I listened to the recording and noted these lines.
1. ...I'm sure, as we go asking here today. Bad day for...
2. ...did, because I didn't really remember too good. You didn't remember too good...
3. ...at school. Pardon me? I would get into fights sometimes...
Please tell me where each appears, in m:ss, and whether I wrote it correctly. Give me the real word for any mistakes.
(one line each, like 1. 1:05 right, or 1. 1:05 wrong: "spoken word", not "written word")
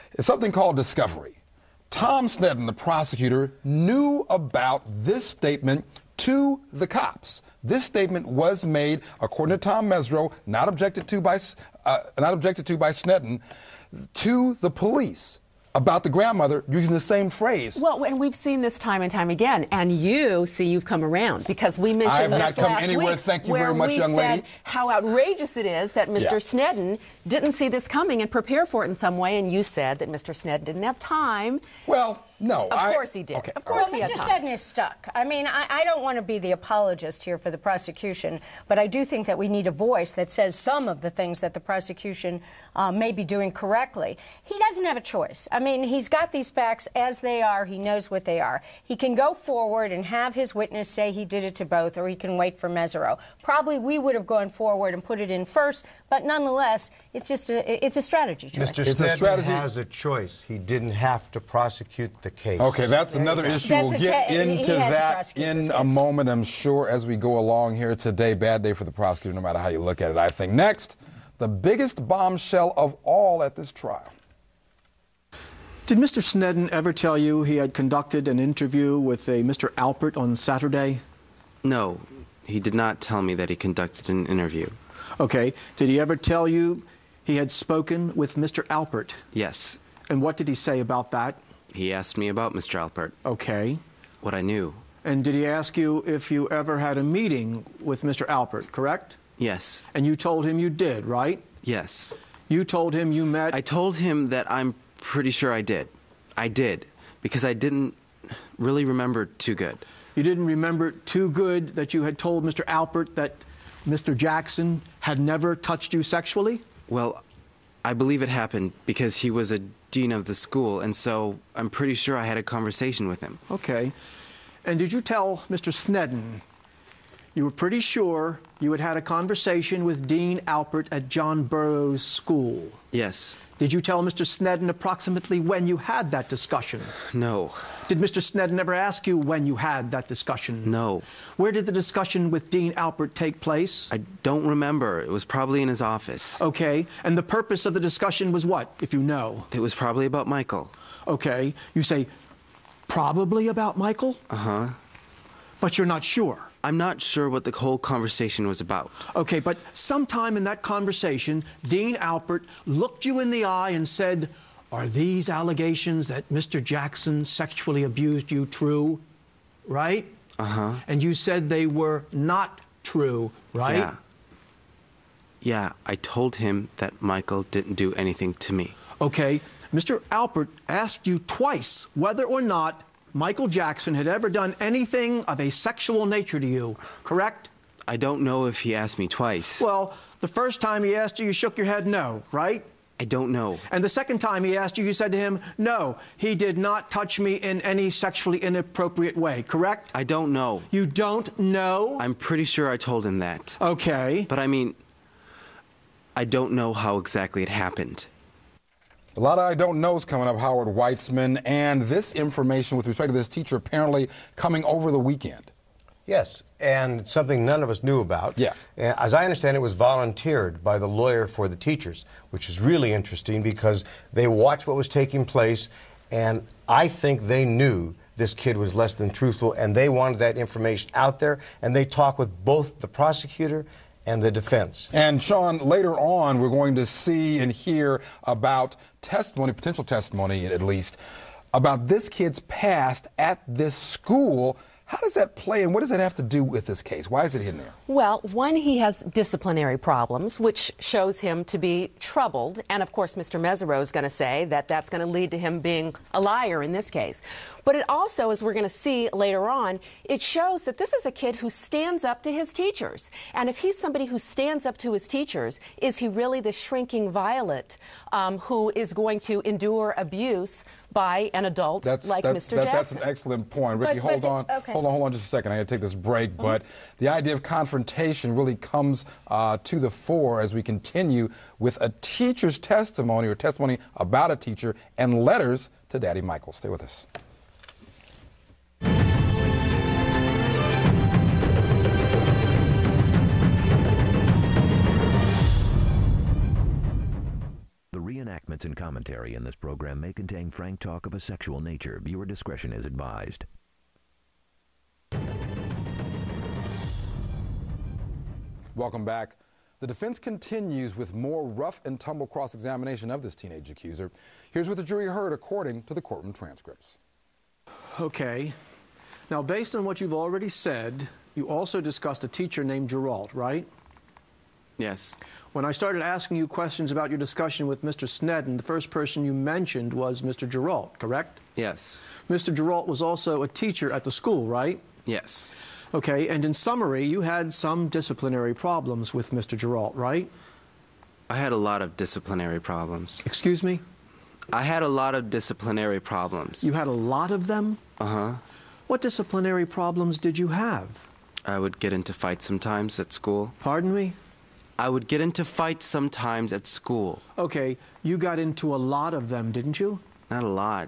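1. 1:06 wrong: "along", not "asking"
2. 1:46 right
3. 5:52 right.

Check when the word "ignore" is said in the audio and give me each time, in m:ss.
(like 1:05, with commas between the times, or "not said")
not said.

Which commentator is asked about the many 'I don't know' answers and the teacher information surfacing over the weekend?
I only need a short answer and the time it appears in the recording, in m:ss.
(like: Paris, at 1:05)
Howard Weitzman, at 3:30.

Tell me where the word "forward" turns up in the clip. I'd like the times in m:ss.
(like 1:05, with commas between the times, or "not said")
0:49, 0:54.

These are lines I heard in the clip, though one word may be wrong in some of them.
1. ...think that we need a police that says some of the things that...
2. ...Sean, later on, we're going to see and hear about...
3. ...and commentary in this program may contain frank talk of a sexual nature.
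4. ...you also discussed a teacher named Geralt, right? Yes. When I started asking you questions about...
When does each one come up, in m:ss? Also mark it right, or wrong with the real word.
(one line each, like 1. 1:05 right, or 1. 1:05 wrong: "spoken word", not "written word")
1. 0:39 wrong: "voice", not "police"
2. 3:55 right
3. 4:58 right
4. 5:21 right.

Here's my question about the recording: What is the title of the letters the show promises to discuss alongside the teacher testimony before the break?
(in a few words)
Daddy Michael.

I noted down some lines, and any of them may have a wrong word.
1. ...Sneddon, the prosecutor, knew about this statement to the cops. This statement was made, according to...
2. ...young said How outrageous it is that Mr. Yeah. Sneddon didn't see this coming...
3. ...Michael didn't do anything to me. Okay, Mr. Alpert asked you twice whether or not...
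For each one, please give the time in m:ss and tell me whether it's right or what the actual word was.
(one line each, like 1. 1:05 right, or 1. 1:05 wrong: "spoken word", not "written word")
1. 0:02 right
2. 0:23 right
3. 2:57 right.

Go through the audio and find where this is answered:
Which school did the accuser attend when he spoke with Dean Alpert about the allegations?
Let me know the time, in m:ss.
2:11.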